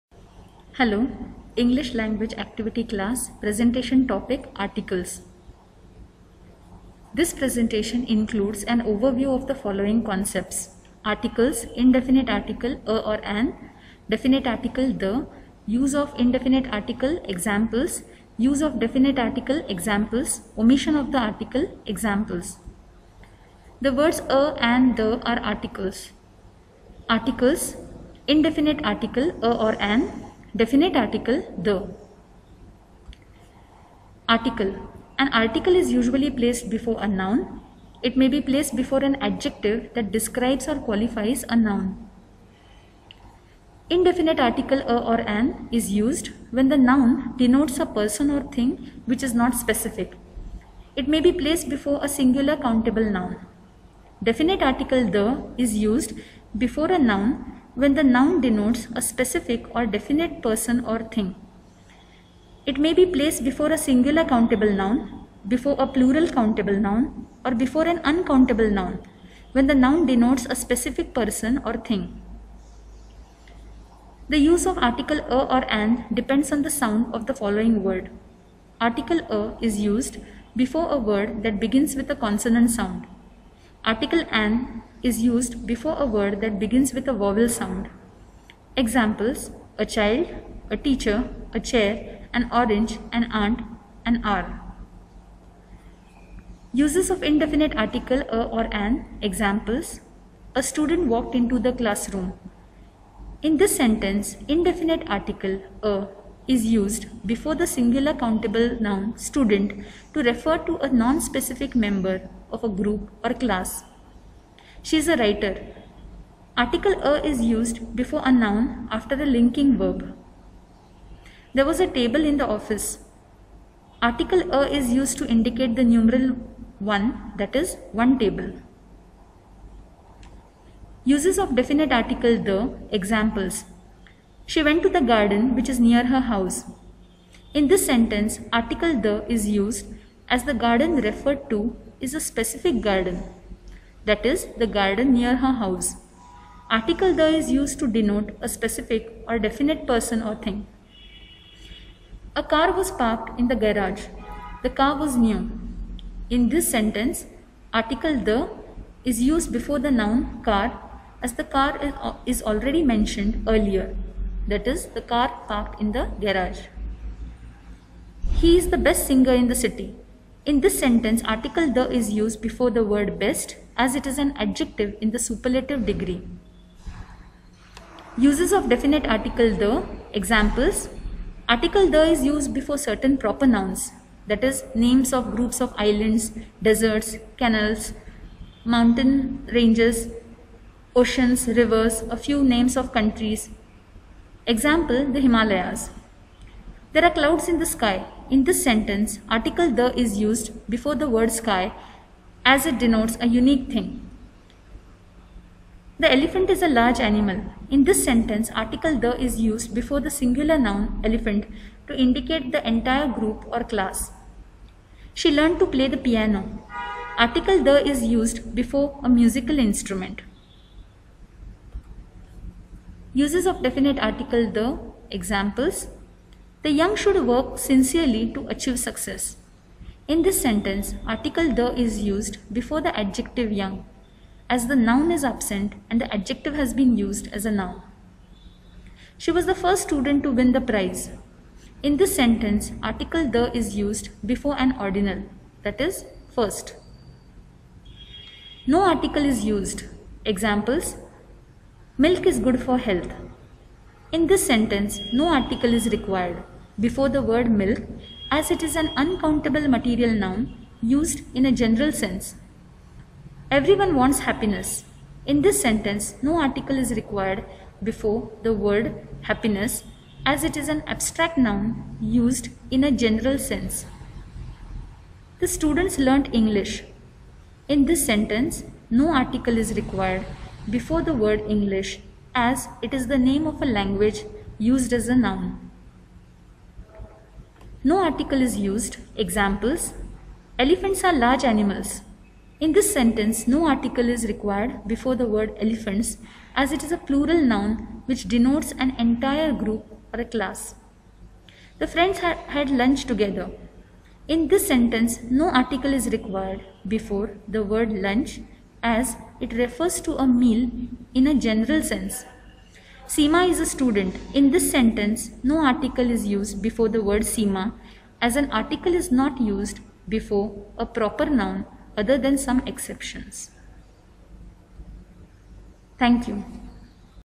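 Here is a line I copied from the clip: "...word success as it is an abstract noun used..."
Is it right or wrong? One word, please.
wrong.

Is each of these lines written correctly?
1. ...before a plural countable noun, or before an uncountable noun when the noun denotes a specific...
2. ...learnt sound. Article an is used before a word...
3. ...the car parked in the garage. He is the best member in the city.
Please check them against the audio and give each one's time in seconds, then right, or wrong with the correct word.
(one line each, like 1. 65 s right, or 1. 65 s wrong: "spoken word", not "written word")
1. 65 s right
2. 82 s wrong: "consonant", not "learnt"
3. 164 s wrong: "singer", not "member".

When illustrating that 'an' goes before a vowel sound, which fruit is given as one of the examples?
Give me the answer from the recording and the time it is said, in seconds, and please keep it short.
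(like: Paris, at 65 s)
orange, at 92 s.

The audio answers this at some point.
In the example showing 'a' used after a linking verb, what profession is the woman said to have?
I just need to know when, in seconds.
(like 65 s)
115 s.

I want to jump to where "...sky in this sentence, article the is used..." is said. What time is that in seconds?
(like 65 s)
197 s.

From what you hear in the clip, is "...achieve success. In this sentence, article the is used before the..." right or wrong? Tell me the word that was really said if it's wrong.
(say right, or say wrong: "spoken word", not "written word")
right.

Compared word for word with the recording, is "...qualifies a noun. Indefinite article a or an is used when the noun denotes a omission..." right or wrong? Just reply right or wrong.
wrong.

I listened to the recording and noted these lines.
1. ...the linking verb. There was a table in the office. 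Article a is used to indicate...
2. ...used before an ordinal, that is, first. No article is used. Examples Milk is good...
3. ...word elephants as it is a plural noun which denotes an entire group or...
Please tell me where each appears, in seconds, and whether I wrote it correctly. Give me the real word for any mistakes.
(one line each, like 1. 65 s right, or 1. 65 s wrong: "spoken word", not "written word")
1. 119 s right
2. 243 s right
3. 295 s right.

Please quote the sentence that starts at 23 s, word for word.
The words a and the are articles.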